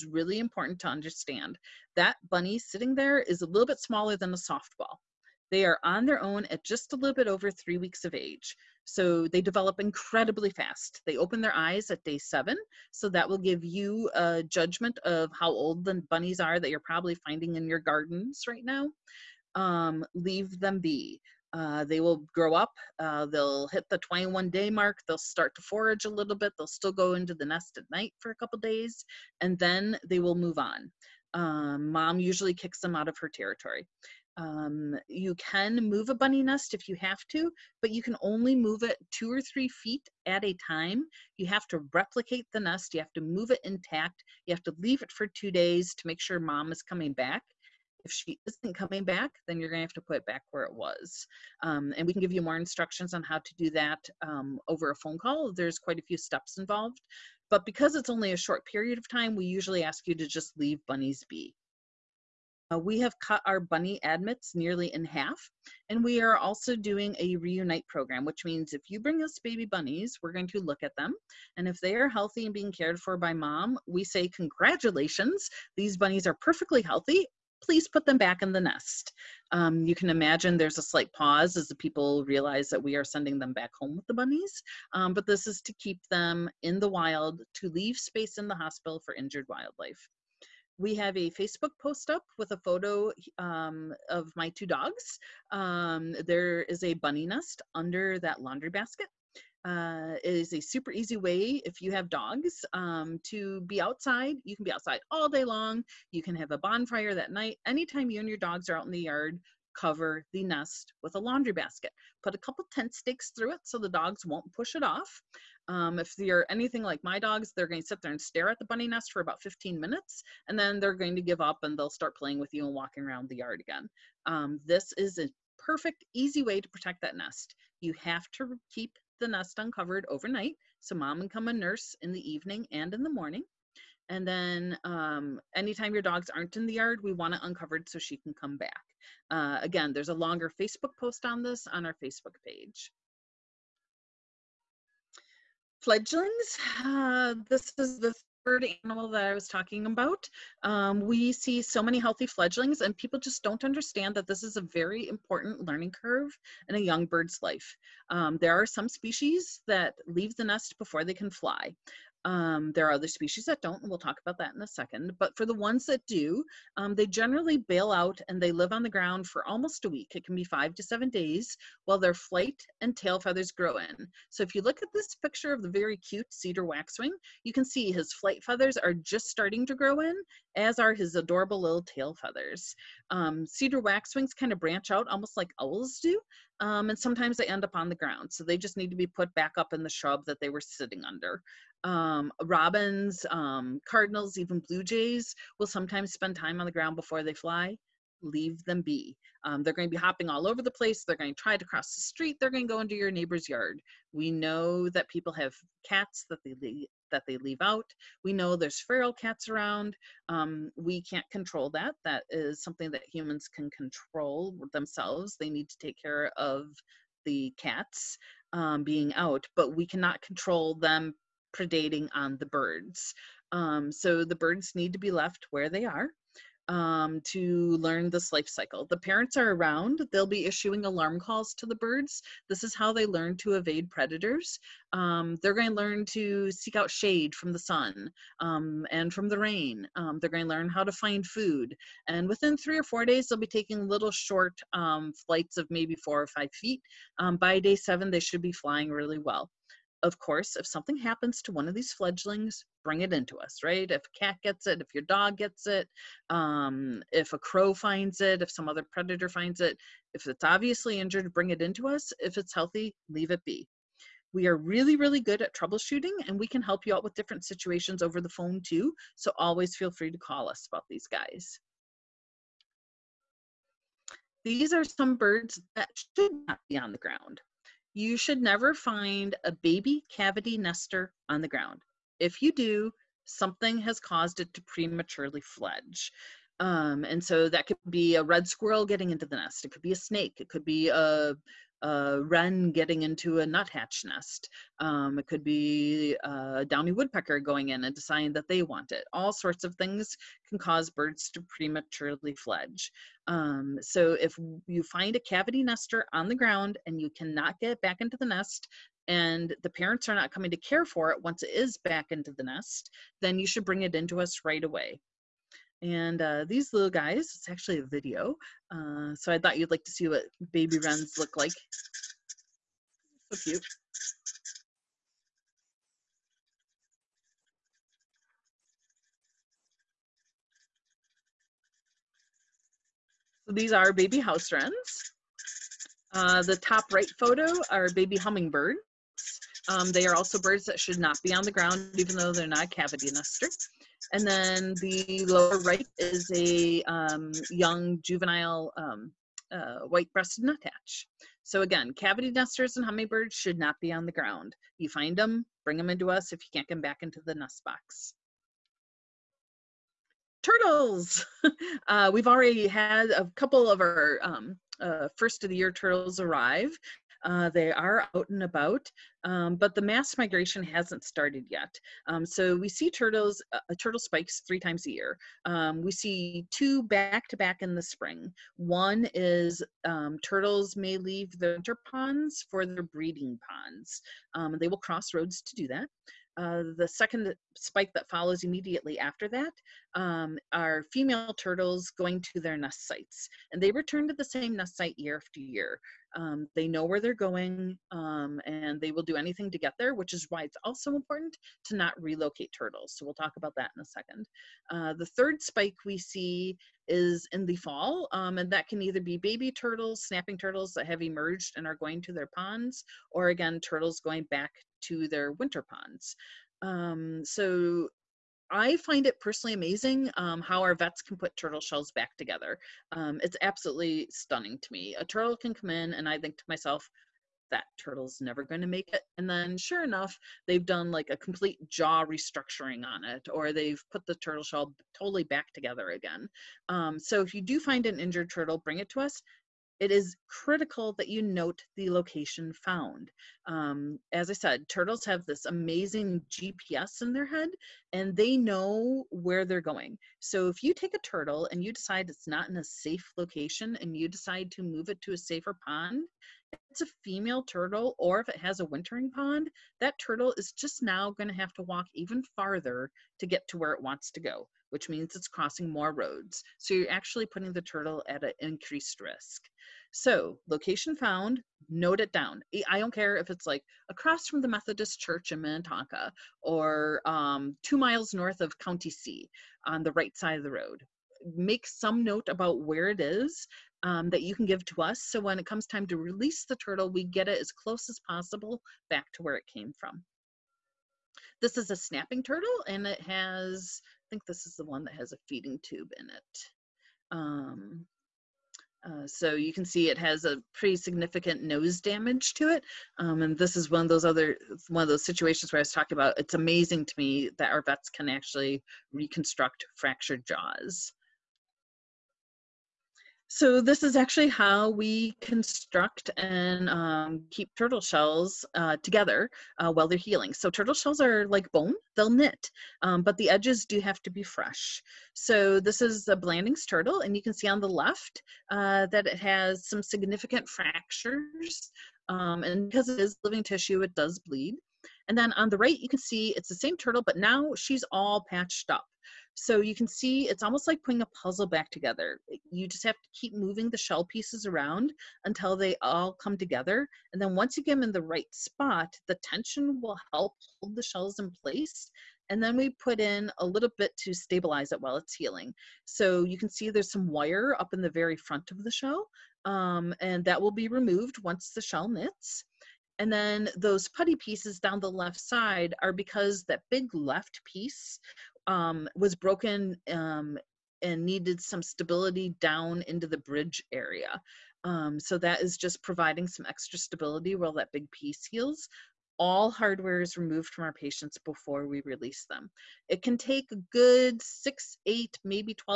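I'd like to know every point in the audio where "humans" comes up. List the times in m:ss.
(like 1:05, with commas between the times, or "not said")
3:33.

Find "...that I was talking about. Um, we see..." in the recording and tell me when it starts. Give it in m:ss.
2:29.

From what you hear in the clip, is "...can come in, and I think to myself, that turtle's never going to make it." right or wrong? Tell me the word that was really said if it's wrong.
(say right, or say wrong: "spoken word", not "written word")
right.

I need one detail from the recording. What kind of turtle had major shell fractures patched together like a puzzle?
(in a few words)
Blanding's turtle.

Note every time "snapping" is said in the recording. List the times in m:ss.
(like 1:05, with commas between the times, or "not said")
6:50, 8:11.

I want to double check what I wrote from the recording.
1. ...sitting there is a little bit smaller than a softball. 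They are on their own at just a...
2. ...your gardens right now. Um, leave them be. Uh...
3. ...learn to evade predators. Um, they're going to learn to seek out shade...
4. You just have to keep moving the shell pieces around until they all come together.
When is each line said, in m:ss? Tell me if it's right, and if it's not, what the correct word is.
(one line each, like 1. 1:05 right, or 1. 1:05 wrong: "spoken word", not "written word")
1. 0:02 right
2. 0:17 right
3. 3:53 right
4. 9:02 right.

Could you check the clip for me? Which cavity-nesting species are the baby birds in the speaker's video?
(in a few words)
House wrens.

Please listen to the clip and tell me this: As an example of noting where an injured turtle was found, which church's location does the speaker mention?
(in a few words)
Methodist Church in Minnetonka.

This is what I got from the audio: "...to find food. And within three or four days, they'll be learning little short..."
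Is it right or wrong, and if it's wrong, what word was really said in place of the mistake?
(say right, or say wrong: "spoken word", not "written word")
wrong: "taking", not "learning".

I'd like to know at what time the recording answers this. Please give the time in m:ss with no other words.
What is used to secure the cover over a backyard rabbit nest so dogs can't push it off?
1:52.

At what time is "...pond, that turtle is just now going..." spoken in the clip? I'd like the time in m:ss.
7:39.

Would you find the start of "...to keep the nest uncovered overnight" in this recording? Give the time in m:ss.
2:08.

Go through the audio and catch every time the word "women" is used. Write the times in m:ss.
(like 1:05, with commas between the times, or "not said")
not said.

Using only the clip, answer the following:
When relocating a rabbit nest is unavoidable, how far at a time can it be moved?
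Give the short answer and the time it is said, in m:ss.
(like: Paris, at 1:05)
2 or 3 feet, at 0:39.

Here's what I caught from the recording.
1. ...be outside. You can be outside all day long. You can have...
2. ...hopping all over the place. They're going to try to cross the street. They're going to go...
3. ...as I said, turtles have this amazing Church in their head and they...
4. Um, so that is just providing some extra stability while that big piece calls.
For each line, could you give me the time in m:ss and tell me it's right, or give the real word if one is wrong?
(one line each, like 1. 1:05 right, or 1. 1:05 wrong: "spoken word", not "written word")
1. 1:43 right
2. 3:19 right
3. 7:24 wrong: "GPS", not "Church"
4. 9:34 wrong: "heals", not "calls".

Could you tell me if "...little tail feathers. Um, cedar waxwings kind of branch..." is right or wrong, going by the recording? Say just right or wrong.
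right.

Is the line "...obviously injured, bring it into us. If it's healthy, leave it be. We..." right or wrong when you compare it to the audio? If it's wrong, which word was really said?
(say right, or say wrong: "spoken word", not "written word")
right.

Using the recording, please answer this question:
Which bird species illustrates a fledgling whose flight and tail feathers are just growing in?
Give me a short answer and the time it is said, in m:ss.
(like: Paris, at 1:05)
Cedar waxwing, at 2:56.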